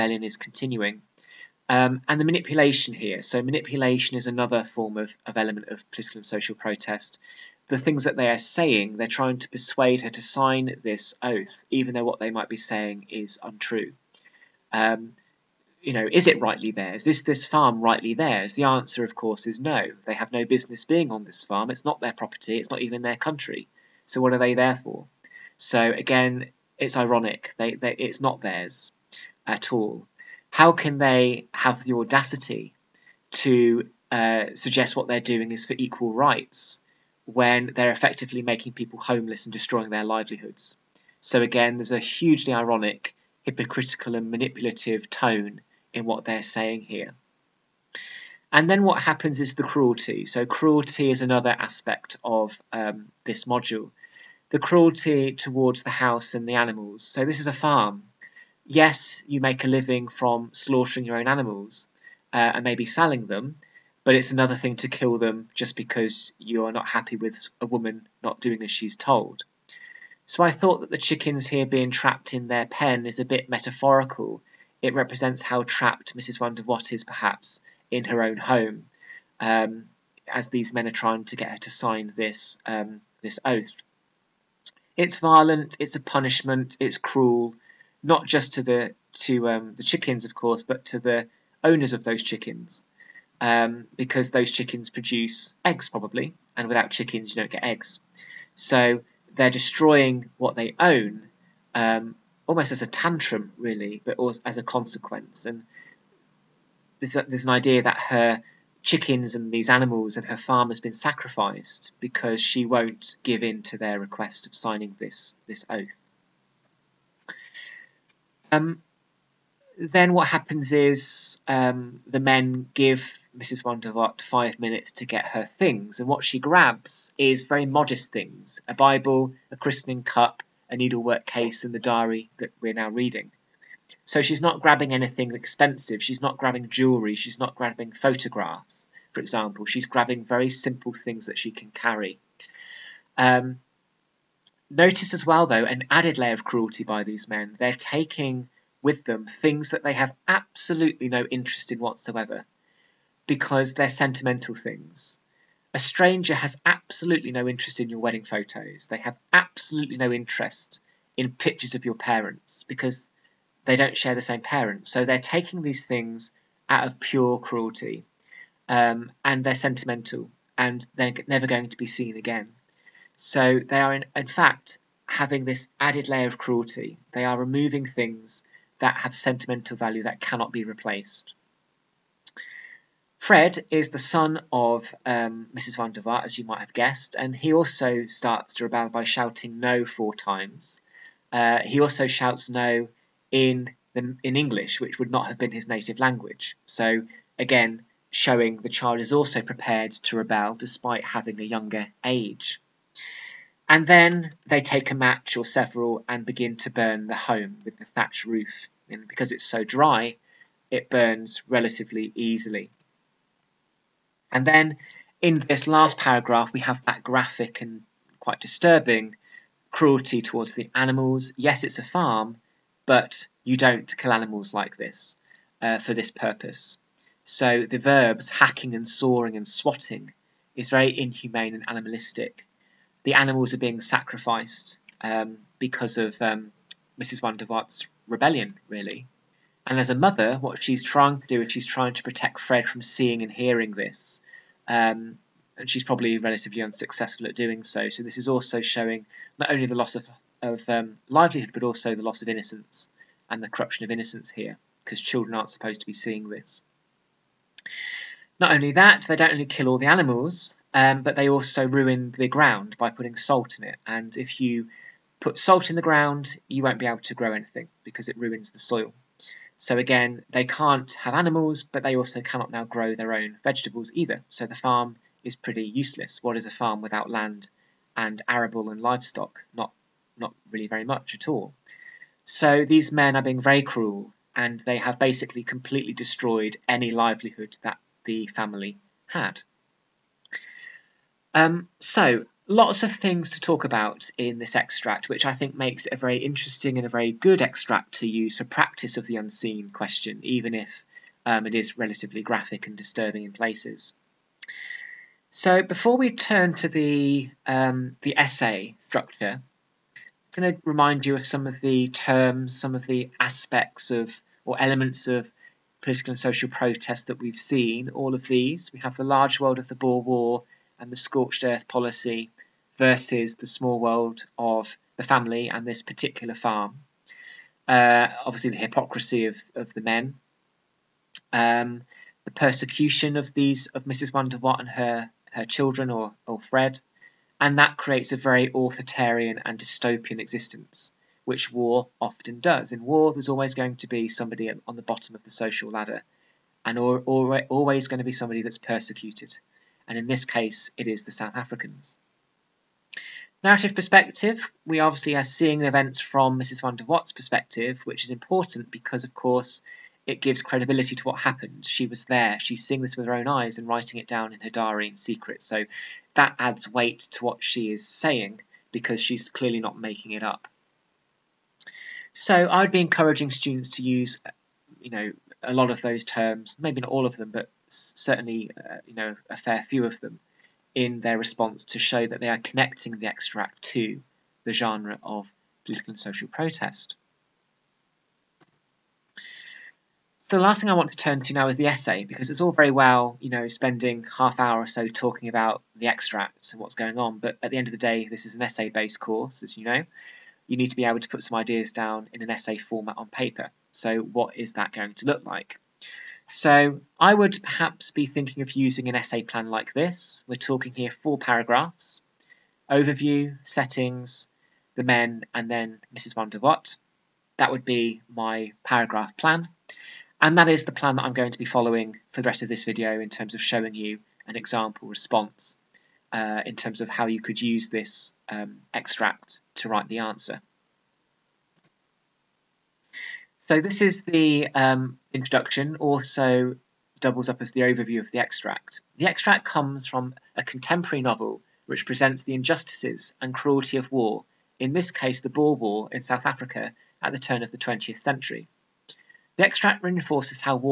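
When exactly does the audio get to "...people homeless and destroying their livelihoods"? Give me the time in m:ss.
0:38.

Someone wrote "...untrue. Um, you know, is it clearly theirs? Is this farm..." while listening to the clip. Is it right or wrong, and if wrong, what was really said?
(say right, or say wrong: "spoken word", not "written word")
wrong: "rightly", not "clearly".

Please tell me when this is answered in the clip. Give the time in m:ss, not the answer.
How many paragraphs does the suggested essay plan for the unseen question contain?
6:50.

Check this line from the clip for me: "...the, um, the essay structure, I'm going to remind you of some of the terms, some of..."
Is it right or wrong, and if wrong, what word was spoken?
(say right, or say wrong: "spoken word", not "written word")
right.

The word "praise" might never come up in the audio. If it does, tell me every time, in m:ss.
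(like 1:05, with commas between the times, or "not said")
not said.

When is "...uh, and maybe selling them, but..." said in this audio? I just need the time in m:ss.
1:02.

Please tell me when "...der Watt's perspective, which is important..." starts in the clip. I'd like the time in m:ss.
5:56.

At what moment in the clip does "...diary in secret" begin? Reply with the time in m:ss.
6:04.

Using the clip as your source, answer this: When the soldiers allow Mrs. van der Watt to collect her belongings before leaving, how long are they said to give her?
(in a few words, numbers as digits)
5 minutes.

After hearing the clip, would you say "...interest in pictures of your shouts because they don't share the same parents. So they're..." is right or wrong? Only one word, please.
wrong.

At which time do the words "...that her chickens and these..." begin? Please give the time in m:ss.
1:47.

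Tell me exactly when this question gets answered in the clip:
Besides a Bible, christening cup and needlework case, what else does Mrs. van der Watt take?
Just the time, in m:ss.
2:11.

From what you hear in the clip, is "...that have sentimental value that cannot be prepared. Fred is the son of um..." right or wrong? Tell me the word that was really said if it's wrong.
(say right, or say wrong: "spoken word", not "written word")
wrong: "replaced", not "prepared".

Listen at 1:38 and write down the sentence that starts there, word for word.
So they're destroying what they own um, almost as a tantrum, really, but also as a consequence.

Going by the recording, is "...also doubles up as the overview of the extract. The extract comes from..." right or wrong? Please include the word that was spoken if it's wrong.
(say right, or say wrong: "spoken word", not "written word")
right.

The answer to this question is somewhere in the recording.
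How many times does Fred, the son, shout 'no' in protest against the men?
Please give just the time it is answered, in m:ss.
3:09.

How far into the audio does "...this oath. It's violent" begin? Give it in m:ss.
1:23.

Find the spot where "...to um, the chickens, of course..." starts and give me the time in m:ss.
1:29.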